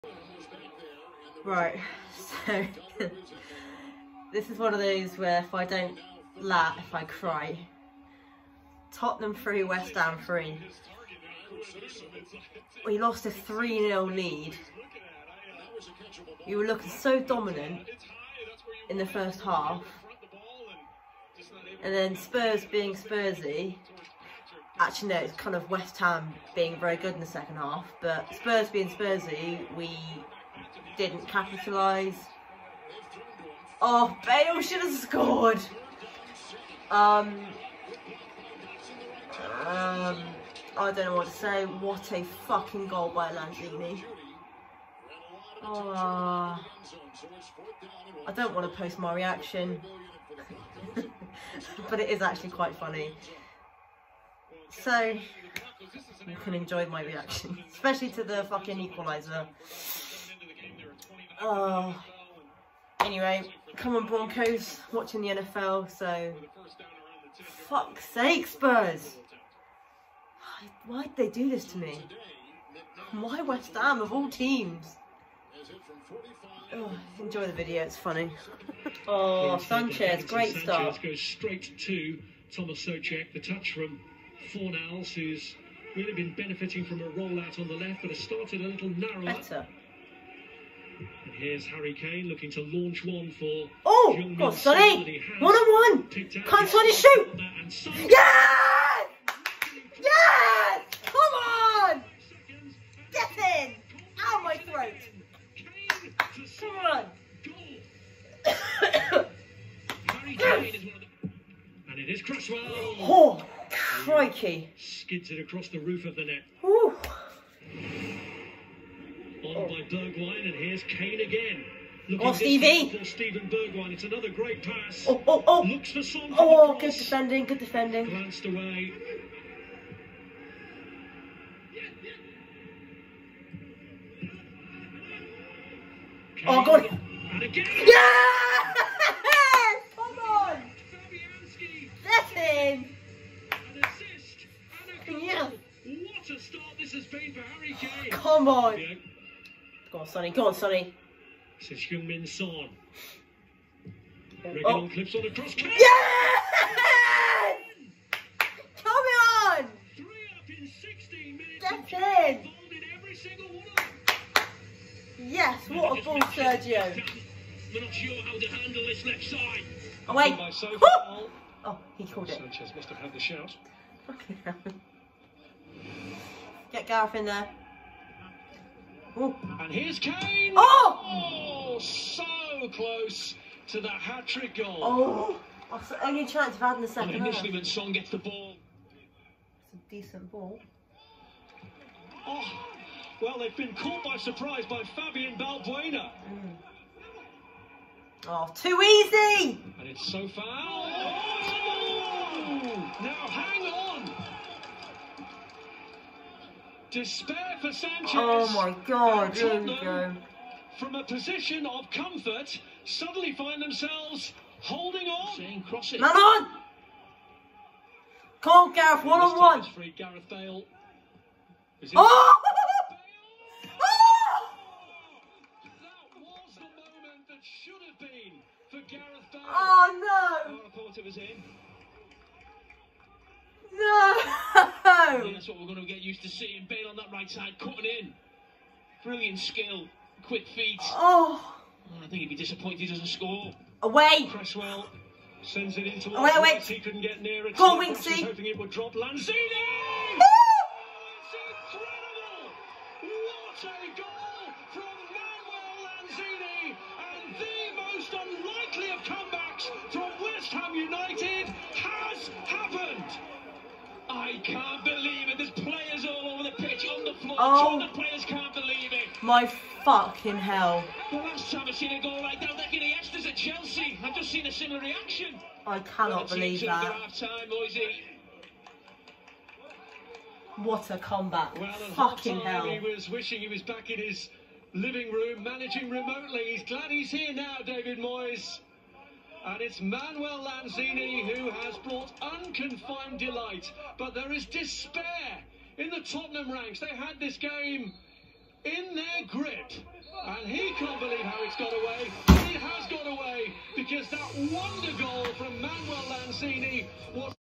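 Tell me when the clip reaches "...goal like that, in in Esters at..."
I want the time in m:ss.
4:32.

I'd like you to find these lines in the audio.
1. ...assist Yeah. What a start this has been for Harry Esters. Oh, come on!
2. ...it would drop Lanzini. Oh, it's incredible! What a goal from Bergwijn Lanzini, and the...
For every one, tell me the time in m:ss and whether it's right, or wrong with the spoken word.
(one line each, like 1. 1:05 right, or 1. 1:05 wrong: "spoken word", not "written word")
1. 2:23 wrong: "Kane", not "Esters"
2. 4:08 wrong: "Manuel", not "Bergwijn".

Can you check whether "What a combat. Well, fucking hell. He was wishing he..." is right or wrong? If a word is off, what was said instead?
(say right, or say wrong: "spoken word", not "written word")
right.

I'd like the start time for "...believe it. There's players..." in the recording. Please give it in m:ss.
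4:24.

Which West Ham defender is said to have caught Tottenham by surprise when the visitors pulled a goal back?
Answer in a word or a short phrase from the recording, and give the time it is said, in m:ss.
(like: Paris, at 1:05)
Fabian Balbuena, at 3:14.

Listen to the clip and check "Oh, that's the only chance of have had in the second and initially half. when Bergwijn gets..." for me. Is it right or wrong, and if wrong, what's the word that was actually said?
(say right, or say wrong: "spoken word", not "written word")
wrong: "Song", not "Bergwijn".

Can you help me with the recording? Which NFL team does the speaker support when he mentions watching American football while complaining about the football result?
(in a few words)
Broncos.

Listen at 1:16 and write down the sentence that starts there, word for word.
Oh, enjoy the video, it's funny.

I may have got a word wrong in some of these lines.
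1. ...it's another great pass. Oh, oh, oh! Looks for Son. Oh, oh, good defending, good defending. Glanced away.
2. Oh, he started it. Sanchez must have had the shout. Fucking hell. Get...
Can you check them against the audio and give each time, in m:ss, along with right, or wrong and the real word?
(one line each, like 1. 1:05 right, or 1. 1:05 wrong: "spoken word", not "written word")
1. 2:03 right
2. 2:51 wrong: "called", not "started".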